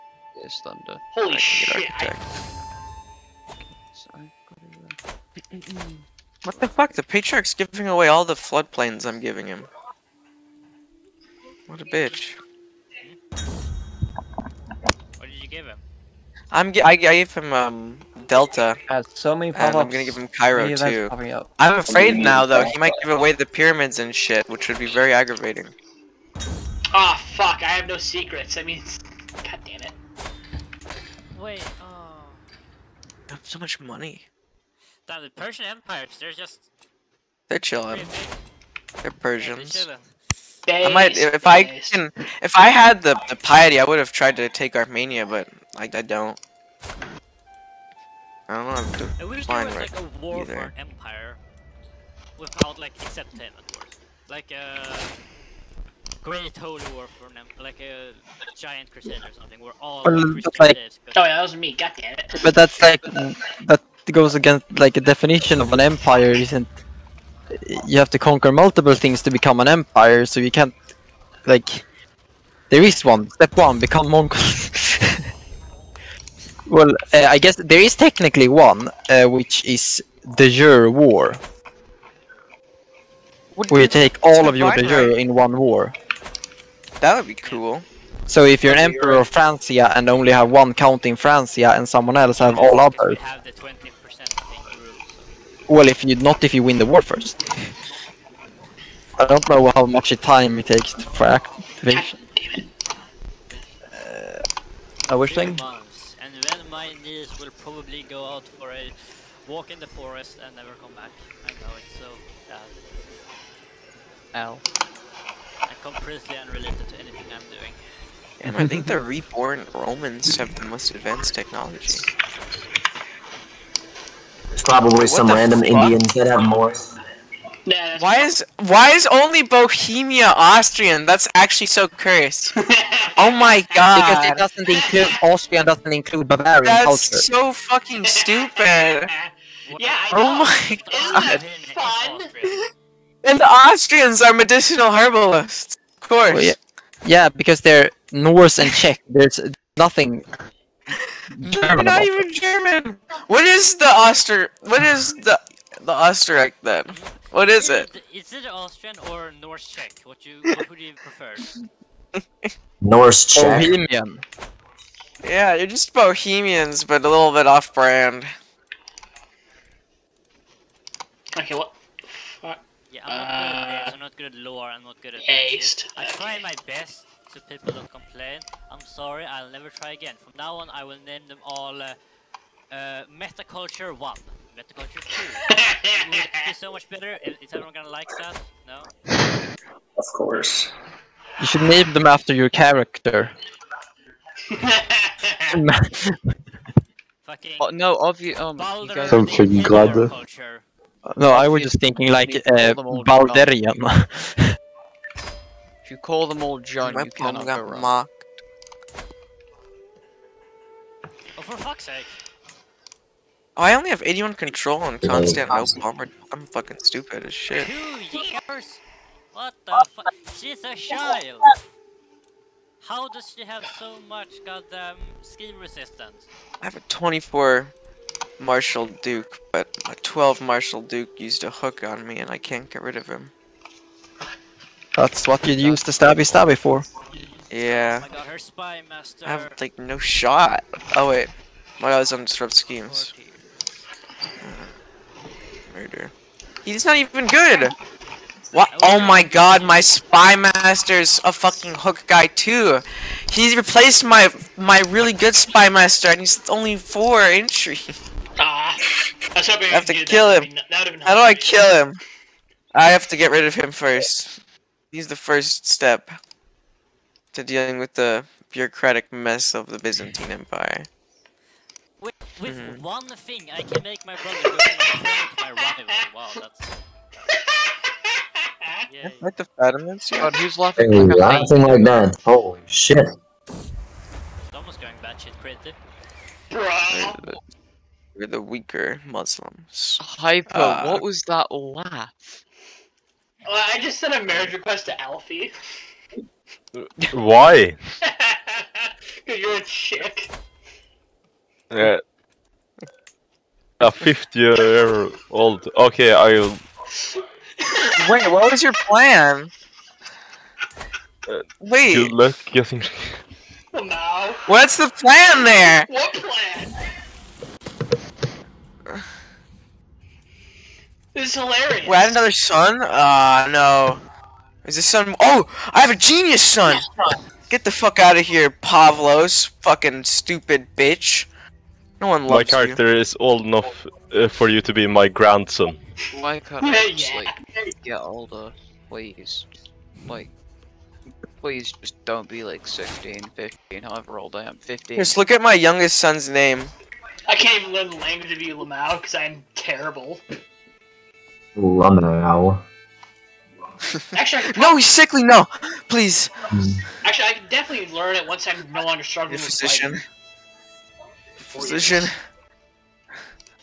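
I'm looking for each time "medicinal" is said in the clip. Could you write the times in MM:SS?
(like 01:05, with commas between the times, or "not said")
02:24.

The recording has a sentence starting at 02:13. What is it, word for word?
Because it doesn't include Austrian, doesn't include Bavarian That's culture.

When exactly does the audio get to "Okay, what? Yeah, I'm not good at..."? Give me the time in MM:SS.
02:51.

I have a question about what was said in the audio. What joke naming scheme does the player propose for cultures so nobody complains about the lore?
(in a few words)
Metaculture 1.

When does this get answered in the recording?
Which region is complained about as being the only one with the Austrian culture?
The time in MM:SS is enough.
02:09.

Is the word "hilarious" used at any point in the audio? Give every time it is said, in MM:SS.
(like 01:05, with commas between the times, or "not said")
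05:21.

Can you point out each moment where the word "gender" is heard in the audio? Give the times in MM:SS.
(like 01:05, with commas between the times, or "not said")
not said.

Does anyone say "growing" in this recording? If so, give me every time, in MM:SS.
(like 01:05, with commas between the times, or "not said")
not said.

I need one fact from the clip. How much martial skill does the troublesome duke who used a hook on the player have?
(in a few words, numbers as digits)
12.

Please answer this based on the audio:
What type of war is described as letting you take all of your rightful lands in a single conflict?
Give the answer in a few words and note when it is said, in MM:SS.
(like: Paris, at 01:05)
De jure war, at 01:20.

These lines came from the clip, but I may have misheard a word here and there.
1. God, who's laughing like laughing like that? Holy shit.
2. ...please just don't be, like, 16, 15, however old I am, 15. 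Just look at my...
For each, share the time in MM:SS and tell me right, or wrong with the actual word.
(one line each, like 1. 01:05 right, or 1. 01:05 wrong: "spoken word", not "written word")
1. 04:40 right
2. 05:41 right.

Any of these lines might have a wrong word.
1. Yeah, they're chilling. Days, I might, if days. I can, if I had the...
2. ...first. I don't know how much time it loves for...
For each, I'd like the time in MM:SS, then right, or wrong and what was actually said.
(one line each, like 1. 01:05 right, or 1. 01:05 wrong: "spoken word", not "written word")
1. 00:39 right
2. 01:37 wrong: "takes", not "loves".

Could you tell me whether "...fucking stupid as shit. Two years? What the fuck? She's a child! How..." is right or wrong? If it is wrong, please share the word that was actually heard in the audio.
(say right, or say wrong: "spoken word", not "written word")
right.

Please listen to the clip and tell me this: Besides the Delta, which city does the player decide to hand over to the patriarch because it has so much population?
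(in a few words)
Cairo.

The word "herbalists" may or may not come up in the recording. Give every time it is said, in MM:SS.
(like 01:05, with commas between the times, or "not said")
02:24.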